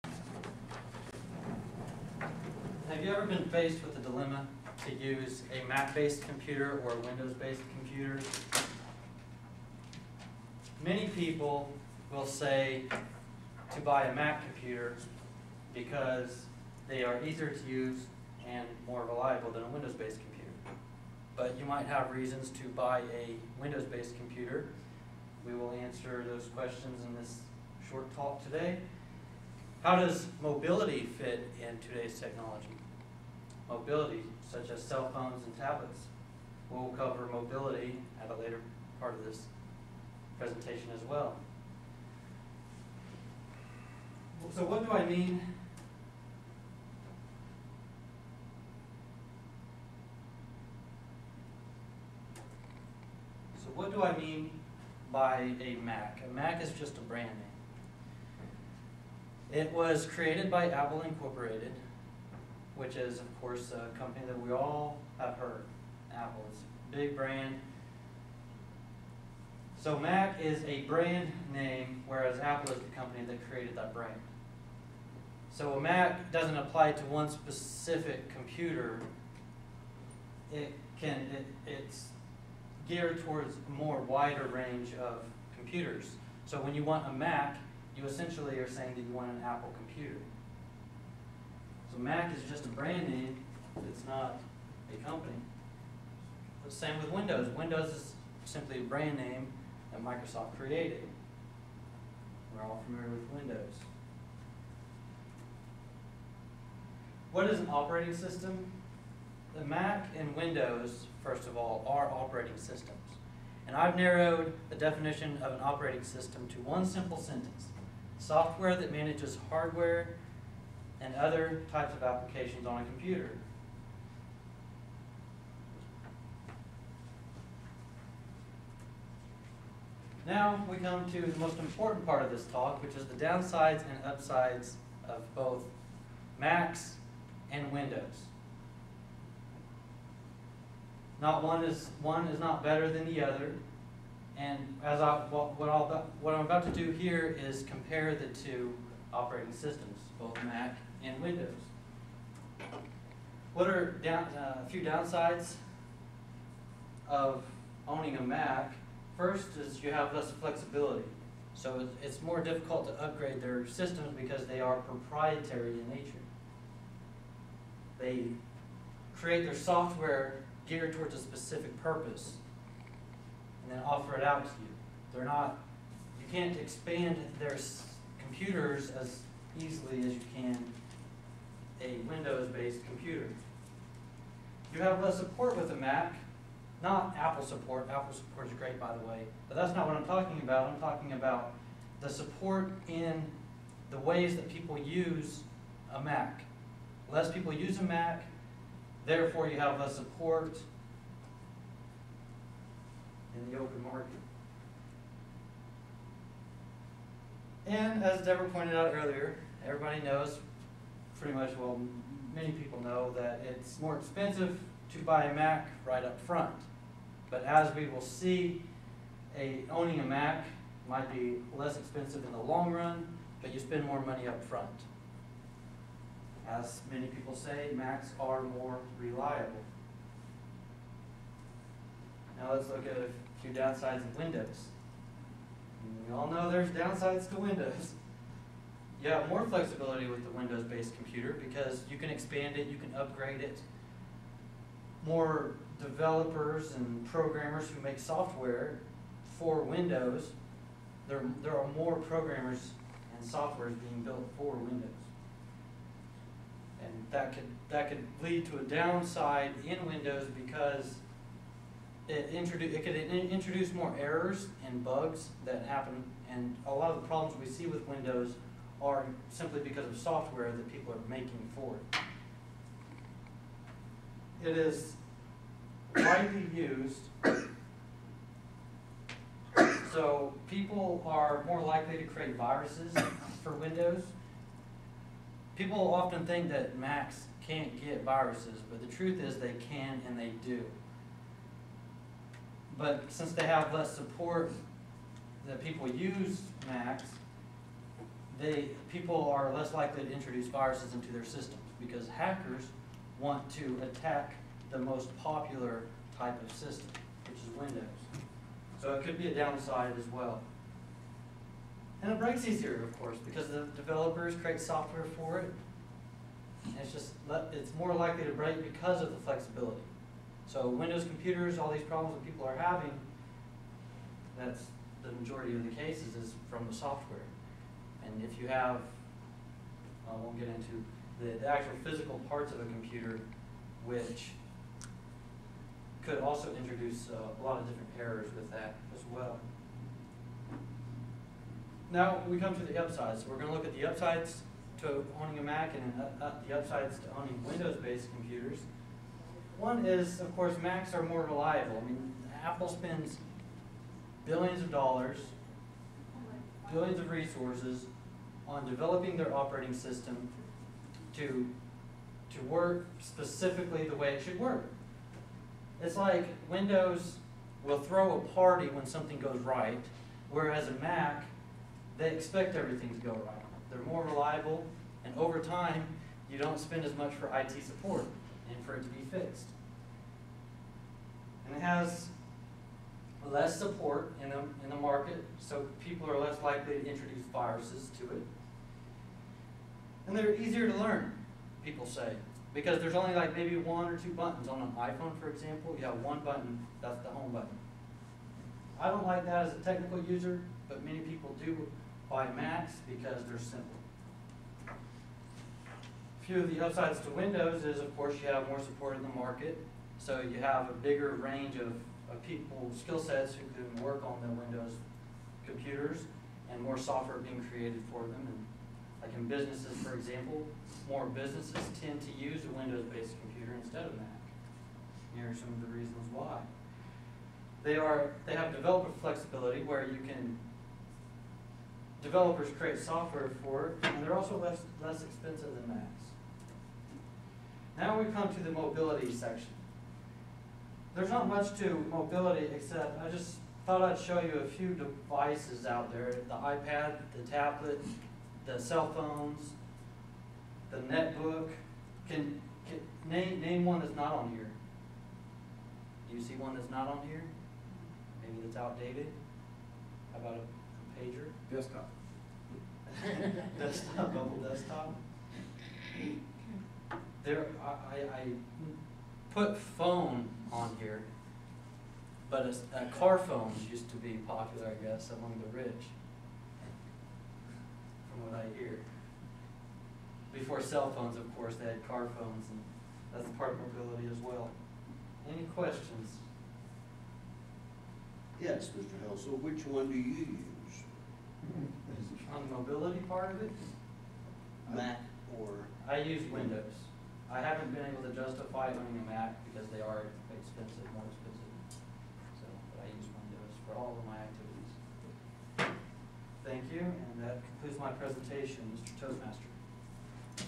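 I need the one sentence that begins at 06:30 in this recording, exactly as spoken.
And they're easier to learn, people say, because there's only like maybe one or two buttons.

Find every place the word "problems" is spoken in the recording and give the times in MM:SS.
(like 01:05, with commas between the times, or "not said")
04:27, 05:21.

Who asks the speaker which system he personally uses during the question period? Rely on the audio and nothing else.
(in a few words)
Mr. Hill.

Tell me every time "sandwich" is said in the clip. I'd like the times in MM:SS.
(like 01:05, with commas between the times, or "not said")
not said.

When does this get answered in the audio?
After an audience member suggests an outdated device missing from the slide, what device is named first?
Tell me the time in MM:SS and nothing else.
07:40.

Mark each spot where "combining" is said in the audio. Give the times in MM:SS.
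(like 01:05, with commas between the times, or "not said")
not said.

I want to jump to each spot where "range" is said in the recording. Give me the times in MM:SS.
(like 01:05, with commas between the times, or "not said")
01:24, 06:51.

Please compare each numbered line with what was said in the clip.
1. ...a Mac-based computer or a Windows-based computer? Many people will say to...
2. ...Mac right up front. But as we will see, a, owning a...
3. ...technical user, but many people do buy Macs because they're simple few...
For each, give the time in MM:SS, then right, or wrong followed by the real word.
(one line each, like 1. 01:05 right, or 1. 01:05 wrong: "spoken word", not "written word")
1. 00:05 right
2. 03:35 right
3. 06:39 right.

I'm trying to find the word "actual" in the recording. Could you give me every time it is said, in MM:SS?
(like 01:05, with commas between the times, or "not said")
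05:31.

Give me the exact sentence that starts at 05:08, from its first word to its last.
So it could be a downside as well.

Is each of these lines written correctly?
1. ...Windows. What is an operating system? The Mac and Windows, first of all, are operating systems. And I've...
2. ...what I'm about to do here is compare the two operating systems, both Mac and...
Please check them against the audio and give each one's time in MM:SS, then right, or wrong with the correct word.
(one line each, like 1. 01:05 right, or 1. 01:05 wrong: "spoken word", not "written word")
1. 01:43 right
2. 02:26 right.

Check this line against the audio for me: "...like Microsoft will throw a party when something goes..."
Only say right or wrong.
wrong.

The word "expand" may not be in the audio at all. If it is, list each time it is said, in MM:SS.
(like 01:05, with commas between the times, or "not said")
02:56, 04:02.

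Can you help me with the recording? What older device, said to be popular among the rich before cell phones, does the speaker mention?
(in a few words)
car phone.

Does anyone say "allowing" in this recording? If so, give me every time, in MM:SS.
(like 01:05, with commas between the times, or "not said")
not said.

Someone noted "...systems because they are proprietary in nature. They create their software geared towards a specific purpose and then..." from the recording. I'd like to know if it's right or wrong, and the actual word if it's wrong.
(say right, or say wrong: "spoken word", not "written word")
right.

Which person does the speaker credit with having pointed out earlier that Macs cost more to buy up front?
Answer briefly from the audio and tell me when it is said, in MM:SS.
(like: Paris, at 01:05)
Deborah, at 03:28.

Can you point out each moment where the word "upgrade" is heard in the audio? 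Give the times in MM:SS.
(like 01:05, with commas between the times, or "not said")
02:43, 04:02.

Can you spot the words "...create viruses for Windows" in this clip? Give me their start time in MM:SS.
04:42.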